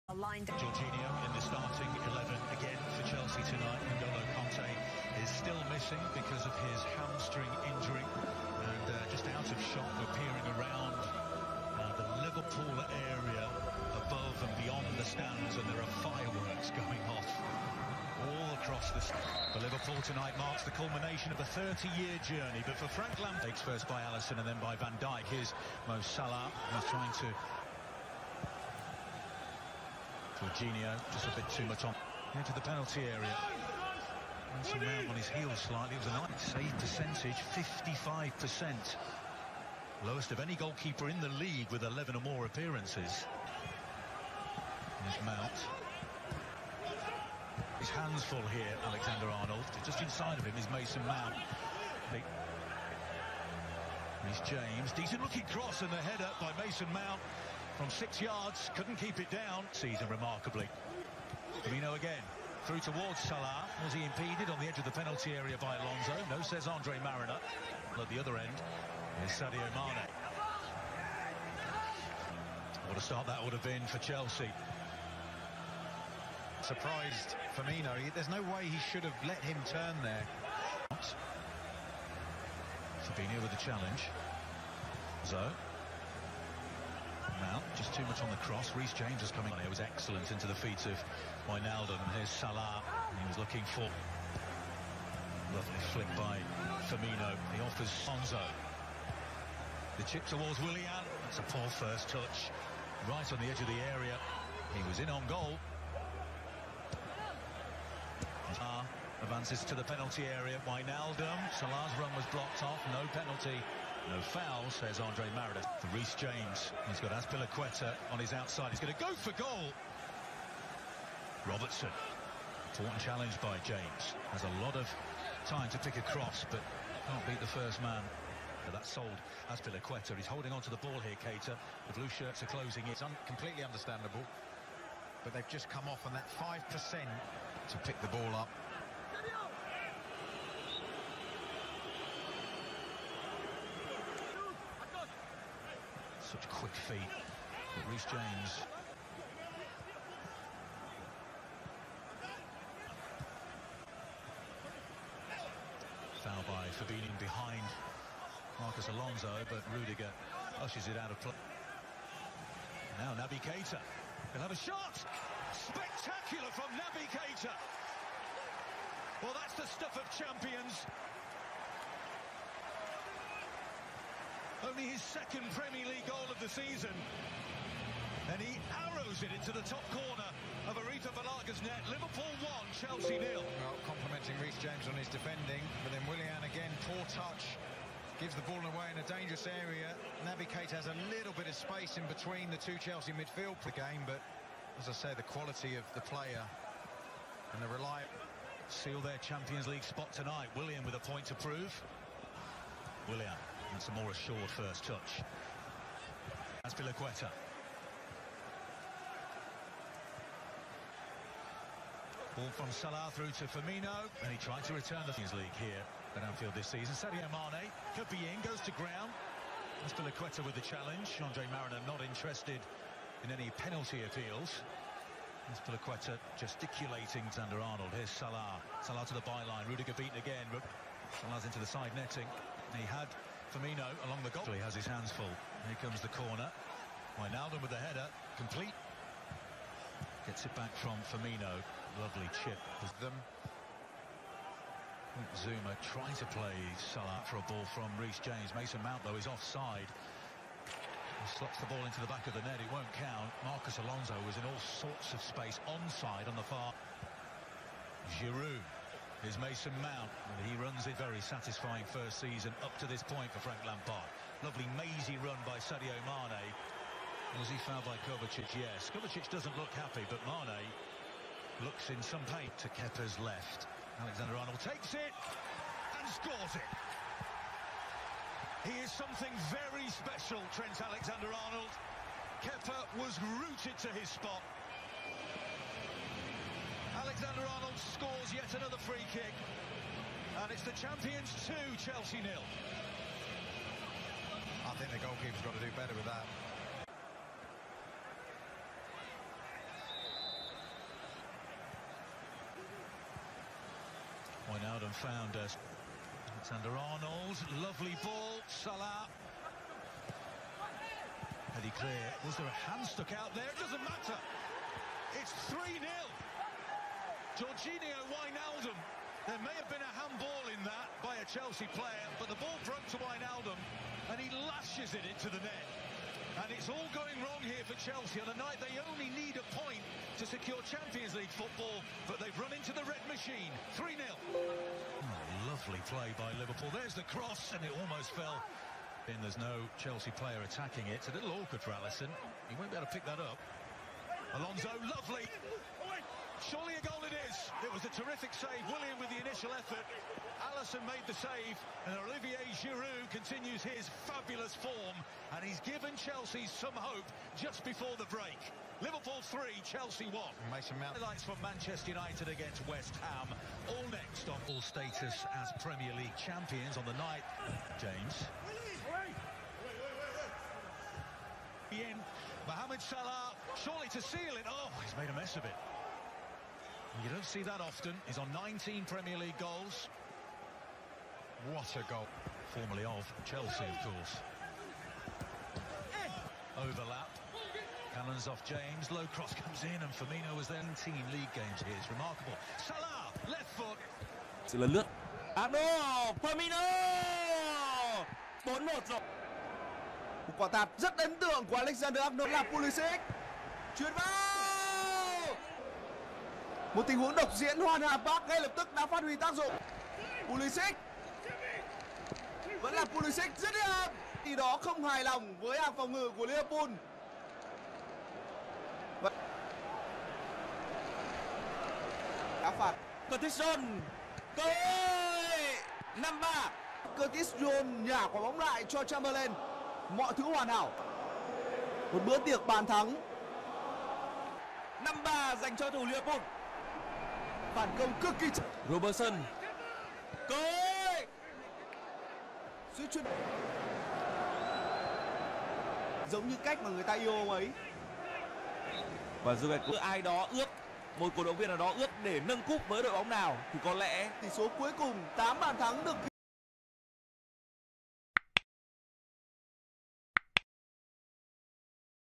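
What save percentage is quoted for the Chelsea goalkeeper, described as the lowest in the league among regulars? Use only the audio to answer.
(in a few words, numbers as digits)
55%.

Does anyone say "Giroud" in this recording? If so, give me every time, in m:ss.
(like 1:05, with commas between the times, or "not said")
4:18, 5:52.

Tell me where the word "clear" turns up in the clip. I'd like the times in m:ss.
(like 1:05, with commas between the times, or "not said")
5:11.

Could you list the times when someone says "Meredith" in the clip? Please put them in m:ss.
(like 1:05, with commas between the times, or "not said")
1:55.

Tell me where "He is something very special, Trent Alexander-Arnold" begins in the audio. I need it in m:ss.
4:38.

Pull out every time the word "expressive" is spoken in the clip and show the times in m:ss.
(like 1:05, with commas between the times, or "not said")
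not said.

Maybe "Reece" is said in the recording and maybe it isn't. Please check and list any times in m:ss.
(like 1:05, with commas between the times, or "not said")
1:28, 2:27, 3:04, 4:07.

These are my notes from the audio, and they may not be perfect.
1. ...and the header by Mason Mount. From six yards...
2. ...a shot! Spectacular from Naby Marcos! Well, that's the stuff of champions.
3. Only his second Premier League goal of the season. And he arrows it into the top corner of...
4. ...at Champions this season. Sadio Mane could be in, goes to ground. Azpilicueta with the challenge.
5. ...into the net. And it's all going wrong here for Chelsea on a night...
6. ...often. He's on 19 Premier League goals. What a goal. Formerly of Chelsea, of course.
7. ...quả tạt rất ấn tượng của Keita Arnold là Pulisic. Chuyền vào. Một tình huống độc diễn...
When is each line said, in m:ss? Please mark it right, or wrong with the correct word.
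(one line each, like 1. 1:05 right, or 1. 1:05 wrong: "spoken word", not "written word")
1. 0:55 right
2. 2:44 wrong: "Keita", not "Marcos"
3. 2:54 right
4. 3:36 wrong: "Anfield", not "Champions"
5. 5:25 right
6. 6:17 right
7. 6:40 wrong: "Alexander", not "Keita".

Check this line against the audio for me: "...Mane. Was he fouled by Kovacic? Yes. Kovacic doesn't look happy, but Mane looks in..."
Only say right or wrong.
right.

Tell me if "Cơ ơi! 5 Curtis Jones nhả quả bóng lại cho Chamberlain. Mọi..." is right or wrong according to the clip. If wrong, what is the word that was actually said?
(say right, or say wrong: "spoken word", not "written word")
right.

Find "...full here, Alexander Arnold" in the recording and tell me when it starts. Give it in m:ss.
0:48.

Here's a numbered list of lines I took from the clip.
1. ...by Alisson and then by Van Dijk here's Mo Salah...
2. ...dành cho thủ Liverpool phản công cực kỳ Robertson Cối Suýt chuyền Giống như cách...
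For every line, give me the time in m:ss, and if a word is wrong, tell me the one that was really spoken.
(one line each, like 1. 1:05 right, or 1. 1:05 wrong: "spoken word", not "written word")
1. 0:23 right
2. 7:15 right.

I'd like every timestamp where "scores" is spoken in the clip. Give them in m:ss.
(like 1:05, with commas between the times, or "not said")
4:36, 4:47.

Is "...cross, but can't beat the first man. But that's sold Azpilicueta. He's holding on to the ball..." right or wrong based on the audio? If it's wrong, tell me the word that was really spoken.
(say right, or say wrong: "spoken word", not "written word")
right.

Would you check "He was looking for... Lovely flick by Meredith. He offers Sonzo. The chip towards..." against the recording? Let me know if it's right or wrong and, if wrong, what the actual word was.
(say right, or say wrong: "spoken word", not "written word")
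wrong: "Firmino", not "Meredith".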